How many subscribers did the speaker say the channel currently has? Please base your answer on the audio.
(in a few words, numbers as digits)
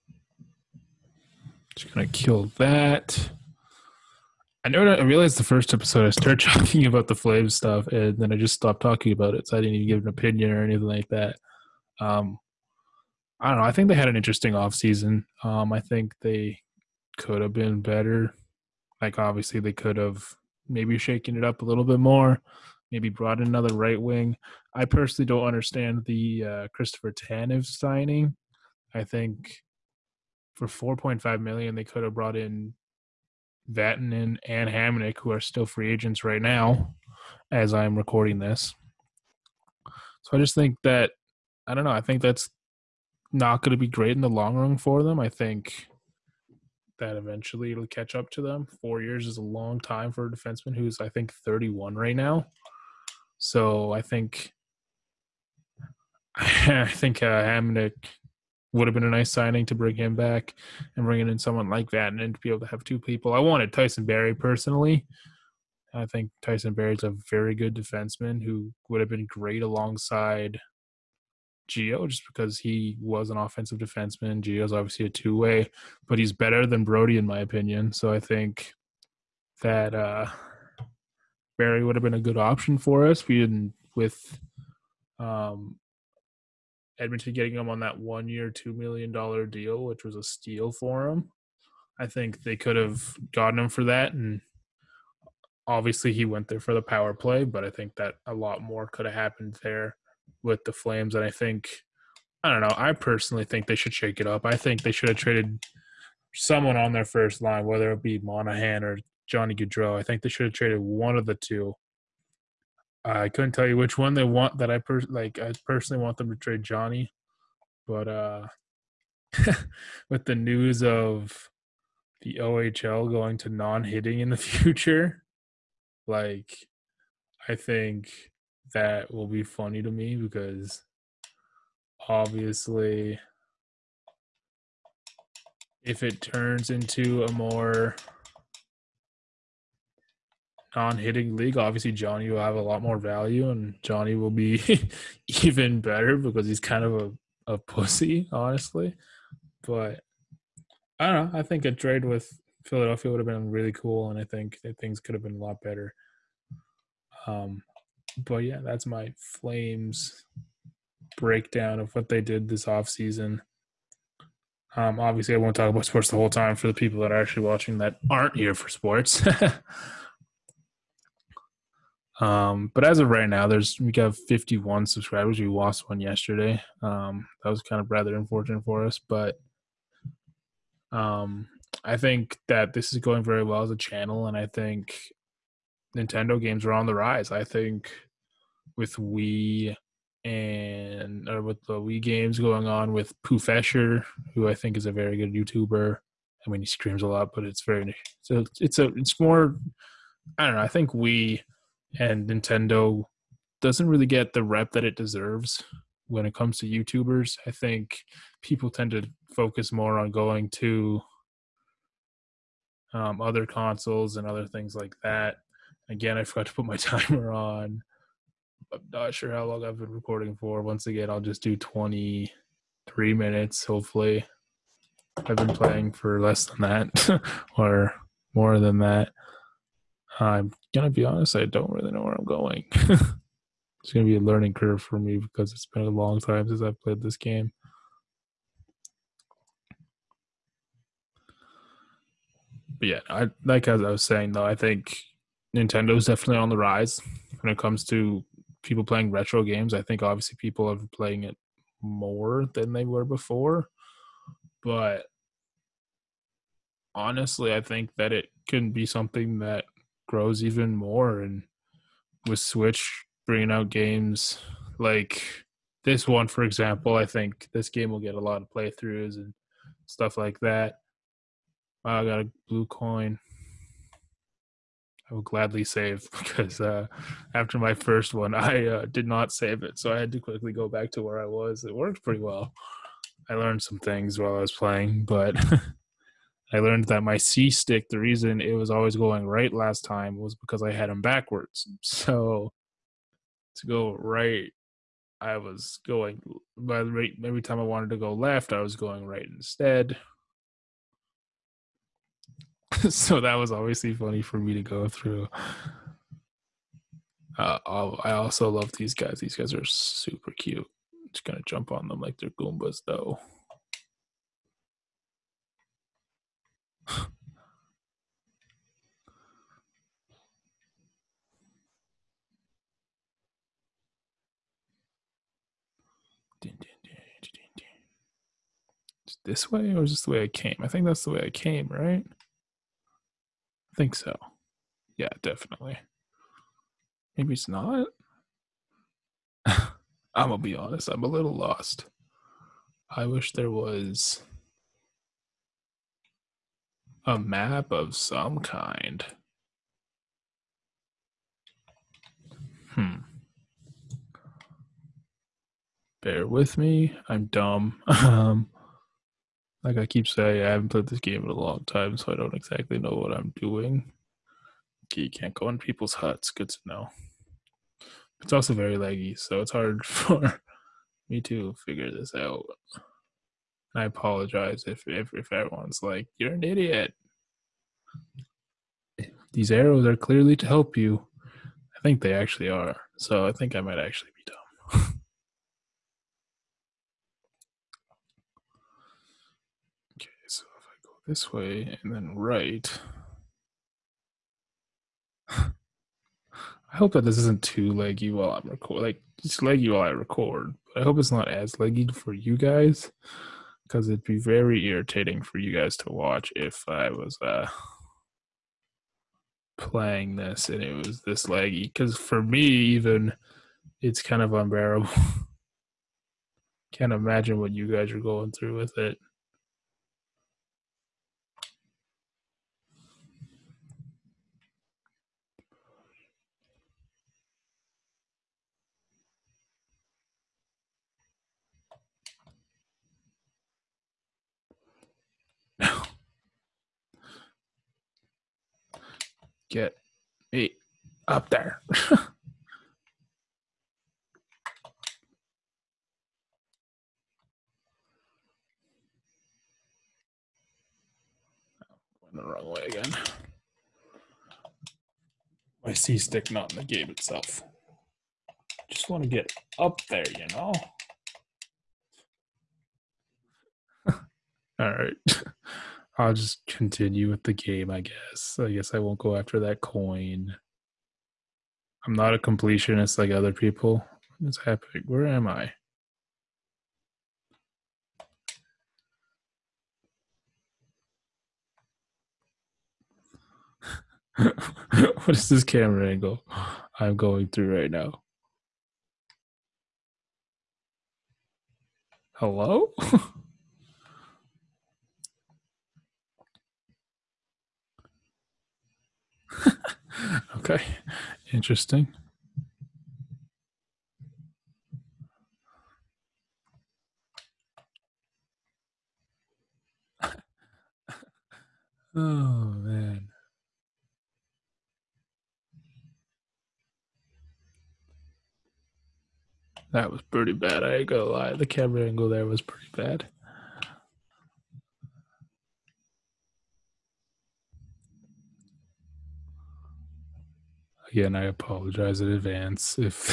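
51.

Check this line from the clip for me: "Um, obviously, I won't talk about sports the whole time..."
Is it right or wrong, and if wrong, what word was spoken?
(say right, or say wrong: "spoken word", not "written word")
right.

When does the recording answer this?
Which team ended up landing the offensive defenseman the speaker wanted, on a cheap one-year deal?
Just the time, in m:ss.
1:26.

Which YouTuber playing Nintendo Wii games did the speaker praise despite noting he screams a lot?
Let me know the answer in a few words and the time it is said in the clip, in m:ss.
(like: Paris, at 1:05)
Pooh Escher, at 3:13.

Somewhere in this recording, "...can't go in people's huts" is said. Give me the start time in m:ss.
6:05.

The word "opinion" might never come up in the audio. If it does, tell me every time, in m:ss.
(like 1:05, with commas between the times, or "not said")
0:10, 1:17.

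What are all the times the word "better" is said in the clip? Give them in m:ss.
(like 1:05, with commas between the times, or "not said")
0:17, 1:16, 2:25, 2:35.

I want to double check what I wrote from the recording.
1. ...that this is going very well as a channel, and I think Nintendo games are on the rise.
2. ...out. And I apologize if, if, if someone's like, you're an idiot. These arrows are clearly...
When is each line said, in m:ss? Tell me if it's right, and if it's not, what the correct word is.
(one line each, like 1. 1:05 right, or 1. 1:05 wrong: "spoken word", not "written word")
1. 3:02 right
2. 6:12 wrong: "everyone", not "someone".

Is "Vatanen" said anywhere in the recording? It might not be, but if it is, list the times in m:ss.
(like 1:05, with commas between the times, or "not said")
0:33.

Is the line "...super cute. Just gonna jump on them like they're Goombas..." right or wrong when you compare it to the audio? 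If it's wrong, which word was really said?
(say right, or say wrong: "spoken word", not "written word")
right.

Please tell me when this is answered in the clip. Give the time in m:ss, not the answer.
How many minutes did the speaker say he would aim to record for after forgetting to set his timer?
3:41.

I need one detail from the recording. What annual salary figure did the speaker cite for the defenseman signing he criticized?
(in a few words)
4.5 million.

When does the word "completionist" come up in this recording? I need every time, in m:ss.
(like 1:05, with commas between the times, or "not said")
7:52.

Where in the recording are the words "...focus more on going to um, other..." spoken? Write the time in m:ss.
3:29.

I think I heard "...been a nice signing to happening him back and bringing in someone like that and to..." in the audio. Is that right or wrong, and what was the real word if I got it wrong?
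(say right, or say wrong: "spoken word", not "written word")
wrong: "bring", not "happening".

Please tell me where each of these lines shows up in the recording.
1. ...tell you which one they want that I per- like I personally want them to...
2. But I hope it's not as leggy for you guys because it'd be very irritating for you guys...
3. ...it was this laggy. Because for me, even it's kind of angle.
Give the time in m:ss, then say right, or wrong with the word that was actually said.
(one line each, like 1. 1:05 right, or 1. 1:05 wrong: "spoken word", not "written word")
1. 1:53 right
2. 6:40 right
3. 6:50 wrong: "unbearable", not "angle".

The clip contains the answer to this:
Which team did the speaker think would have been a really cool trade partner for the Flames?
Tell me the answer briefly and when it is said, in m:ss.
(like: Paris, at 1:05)
Philadelphia, at 2:32.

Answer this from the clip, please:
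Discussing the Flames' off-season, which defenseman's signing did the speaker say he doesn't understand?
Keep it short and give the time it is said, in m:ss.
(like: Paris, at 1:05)
Christopher Tanev, at 0:26.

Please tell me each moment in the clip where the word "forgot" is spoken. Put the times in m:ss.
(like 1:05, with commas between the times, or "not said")
3:36.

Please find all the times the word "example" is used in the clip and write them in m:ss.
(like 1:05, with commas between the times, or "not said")
4:26.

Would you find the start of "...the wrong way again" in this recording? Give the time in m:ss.
7:32.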